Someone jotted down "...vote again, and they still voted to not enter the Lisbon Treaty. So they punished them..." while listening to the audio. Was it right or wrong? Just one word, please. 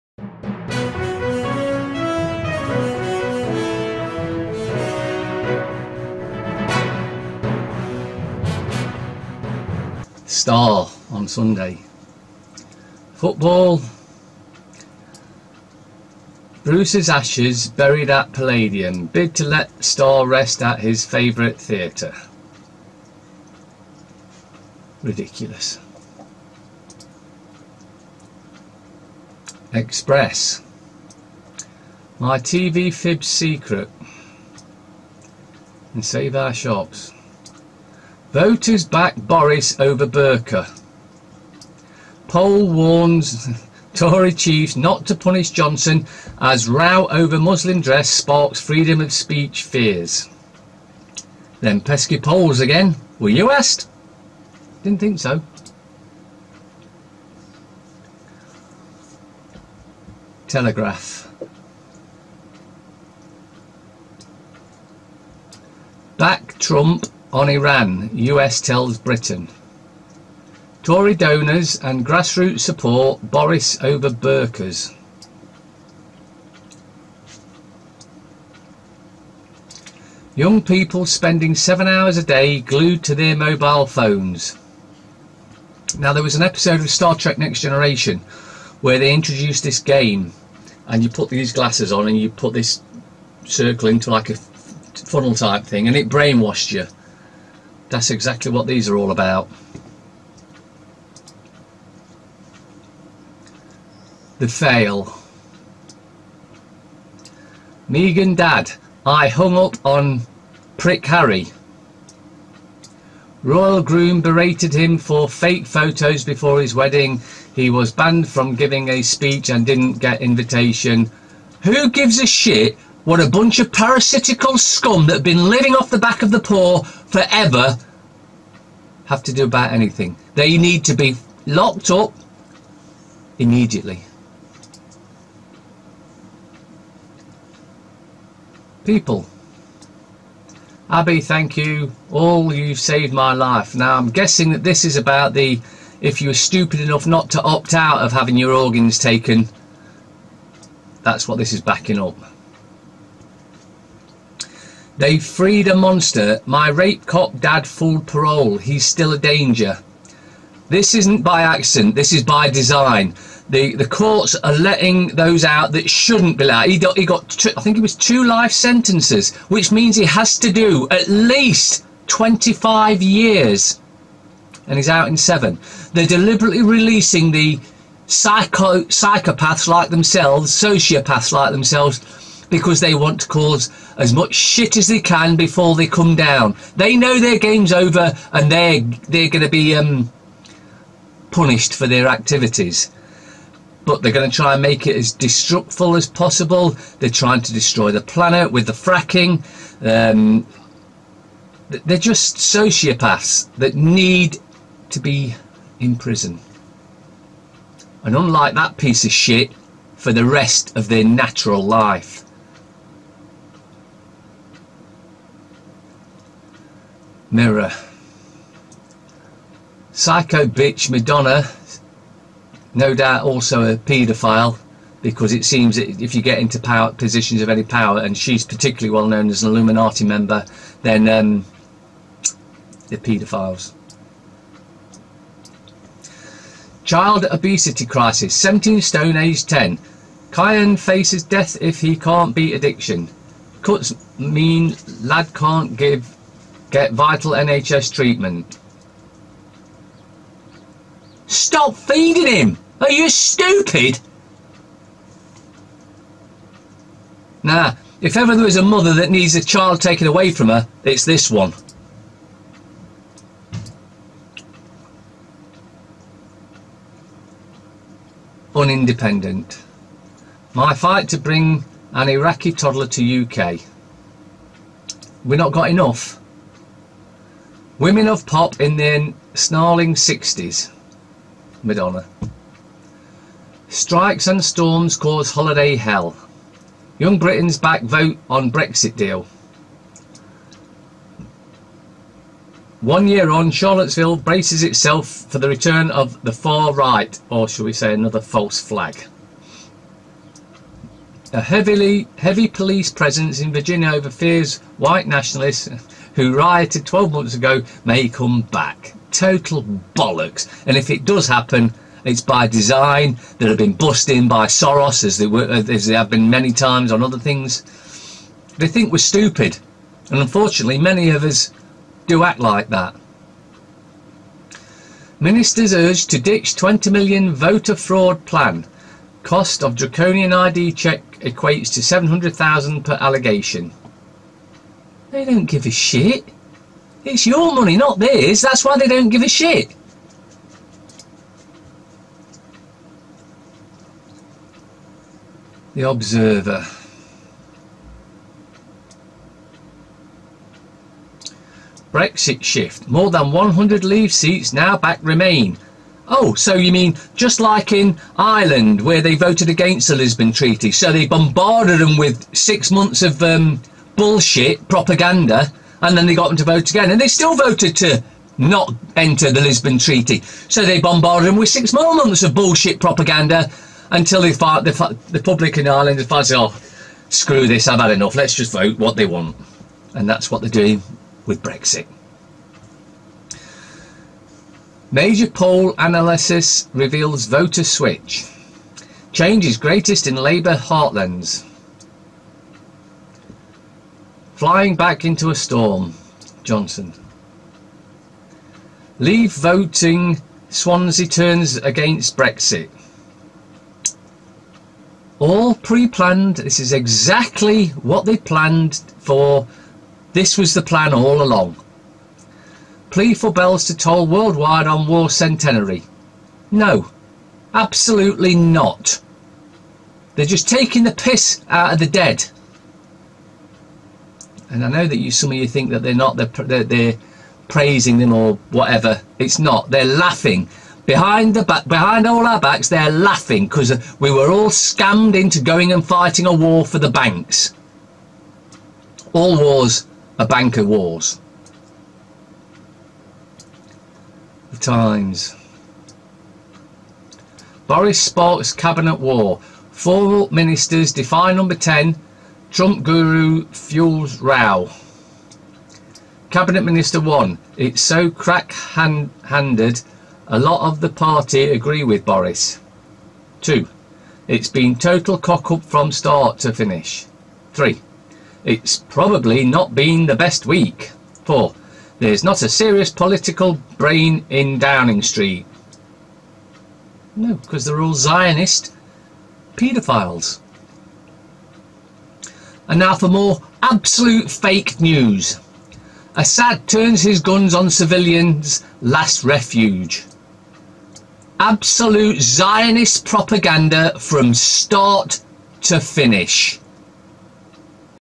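wrong.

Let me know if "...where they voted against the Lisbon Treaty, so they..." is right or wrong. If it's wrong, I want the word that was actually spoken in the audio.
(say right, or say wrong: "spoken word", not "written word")
right.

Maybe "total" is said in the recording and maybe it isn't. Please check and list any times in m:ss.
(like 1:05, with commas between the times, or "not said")
5:09, 7:44.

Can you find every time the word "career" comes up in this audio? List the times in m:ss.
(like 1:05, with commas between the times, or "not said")
not said.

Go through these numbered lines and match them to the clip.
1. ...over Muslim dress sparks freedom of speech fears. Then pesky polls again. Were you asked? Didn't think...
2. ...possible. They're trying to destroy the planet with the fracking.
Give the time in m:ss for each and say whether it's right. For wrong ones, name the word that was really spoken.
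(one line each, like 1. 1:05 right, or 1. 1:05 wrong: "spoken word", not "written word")
1. 0:47 right
2. 3:16 right.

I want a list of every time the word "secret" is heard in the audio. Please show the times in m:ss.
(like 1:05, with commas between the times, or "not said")
0:33.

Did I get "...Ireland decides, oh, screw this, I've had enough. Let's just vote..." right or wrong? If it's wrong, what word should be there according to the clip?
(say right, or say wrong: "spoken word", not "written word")
right.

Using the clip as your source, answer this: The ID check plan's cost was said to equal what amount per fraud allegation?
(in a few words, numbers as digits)
700,000.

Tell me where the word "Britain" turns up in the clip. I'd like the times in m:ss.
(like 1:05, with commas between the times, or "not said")
1:08, 4:47.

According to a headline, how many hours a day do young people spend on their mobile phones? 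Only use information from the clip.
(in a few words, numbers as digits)
7 hours.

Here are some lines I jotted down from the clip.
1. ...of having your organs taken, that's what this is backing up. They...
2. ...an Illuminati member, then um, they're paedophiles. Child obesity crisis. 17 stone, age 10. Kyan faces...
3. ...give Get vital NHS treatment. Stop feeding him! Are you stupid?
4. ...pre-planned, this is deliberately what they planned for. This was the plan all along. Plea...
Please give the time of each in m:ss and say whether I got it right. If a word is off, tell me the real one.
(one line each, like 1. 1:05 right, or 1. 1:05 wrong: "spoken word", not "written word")
1. 2:27 right
2. 3:49 right
3. 4:05 right
4. 6:45 wrong: "exactly", not "deliberately".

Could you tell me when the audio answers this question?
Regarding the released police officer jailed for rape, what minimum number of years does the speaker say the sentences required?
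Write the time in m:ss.
2:52.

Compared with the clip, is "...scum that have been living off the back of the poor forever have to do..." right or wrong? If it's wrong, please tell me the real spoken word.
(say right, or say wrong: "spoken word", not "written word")
right.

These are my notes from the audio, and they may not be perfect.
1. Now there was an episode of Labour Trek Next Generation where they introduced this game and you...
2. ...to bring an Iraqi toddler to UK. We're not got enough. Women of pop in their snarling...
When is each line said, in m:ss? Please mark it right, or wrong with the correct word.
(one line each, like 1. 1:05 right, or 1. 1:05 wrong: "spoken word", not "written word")
1. 1:25 wrong: "Star", not "Labour"
2. 4:31 right.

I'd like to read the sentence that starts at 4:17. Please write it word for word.
Nah, if ever there is a mother that needs a child taken away from her, it's this one.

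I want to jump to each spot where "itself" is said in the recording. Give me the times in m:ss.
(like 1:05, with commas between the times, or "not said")
4:54.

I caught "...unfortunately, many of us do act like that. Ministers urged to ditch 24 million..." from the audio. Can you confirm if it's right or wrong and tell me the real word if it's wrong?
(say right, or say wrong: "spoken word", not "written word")
wrong: "20", not "24".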